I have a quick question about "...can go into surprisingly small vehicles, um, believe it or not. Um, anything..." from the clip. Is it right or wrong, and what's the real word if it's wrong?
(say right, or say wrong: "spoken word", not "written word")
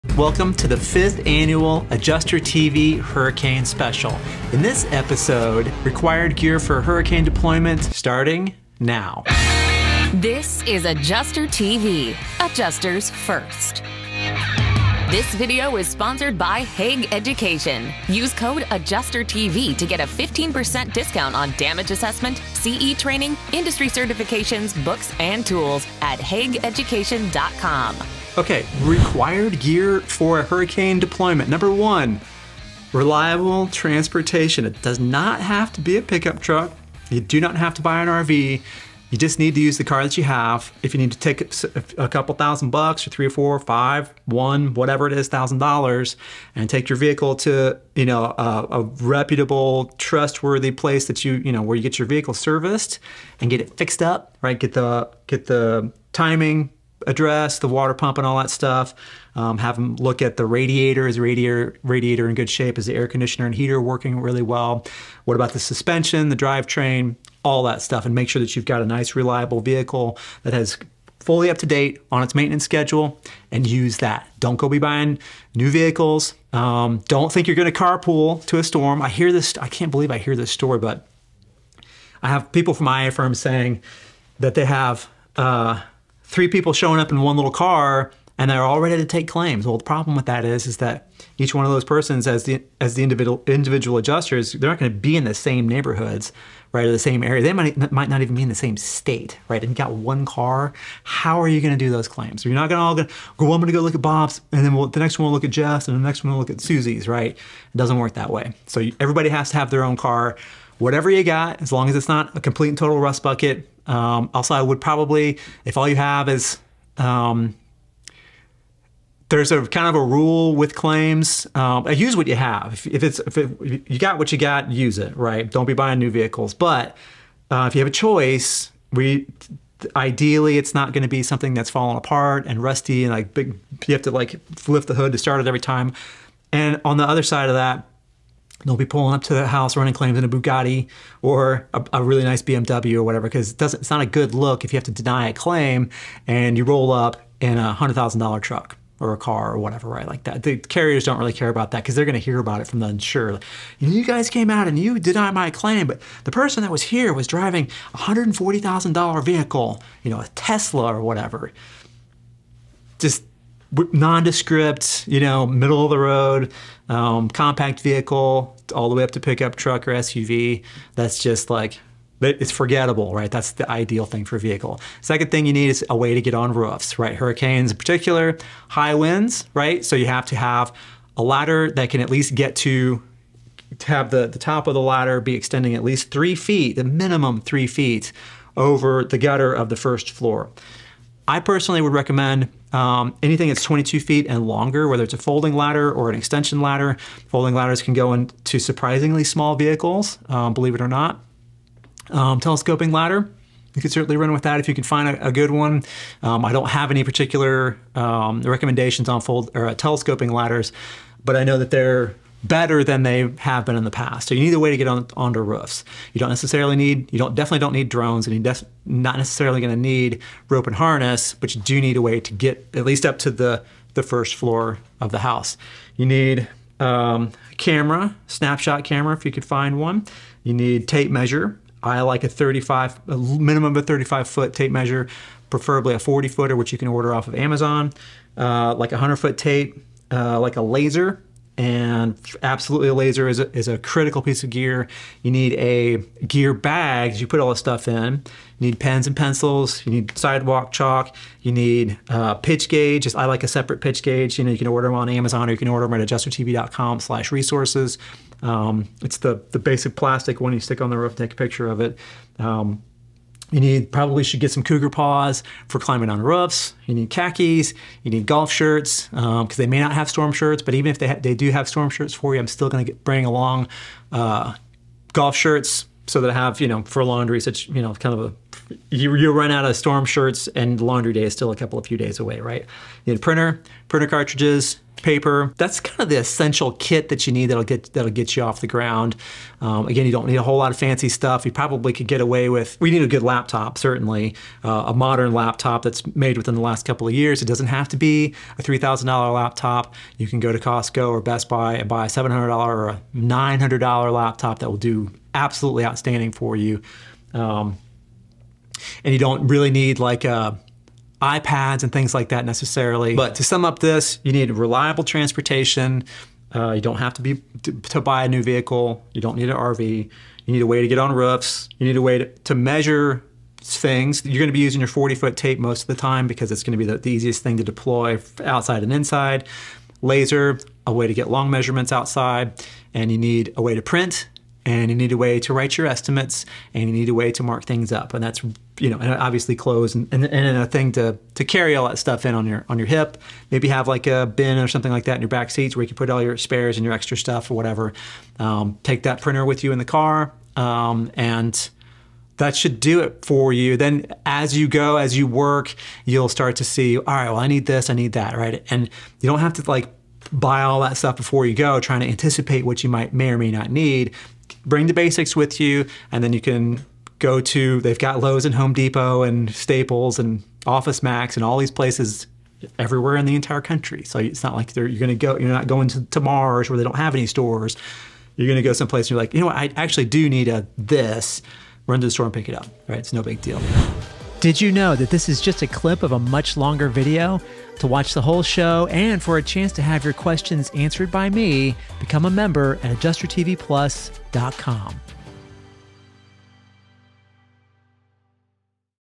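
wrong: "telescoping", not "anything".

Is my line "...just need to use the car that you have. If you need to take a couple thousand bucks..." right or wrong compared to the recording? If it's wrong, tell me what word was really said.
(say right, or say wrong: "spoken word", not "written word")
right.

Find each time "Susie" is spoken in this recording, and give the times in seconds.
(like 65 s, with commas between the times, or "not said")
106 s.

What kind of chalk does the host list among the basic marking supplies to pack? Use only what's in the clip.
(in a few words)
sidewalk chalk.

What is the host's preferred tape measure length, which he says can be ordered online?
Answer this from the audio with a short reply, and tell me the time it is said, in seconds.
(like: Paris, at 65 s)
40 foot, at 235 s.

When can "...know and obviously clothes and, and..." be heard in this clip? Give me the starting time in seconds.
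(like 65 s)
338 s.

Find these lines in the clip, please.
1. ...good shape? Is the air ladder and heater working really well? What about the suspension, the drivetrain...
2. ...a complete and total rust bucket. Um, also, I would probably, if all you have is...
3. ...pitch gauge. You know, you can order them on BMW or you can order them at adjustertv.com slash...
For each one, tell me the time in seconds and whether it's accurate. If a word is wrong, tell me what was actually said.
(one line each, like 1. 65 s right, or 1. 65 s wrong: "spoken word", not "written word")
1. 62 s wrong: "conditioner", not "ladder"
2. 112 s right
3. 253 s wrong: "Amazon", not "BMW".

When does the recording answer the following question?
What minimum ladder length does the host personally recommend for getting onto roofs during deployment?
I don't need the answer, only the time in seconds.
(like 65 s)
193 s.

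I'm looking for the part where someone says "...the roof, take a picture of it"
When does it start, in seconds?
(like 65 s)
260 s.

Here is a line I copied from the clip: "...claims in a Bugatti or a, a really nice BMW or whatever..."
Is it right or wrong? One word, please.
right.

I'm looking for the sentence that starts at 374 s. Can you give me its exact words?
So it's not like you're going to go, you're not going to, to Mars where they don't have any stores.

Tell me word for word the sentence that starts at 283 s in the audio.
You need printer, printer cartridges, paper.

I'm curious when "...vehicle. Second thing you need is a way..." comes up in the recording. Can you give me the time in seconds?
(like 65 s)
174 s.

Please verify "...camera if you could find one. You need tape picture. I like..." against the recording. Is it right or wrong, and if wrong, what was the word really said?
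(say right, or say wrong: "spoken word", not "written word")
wrong: "measure", not "picture".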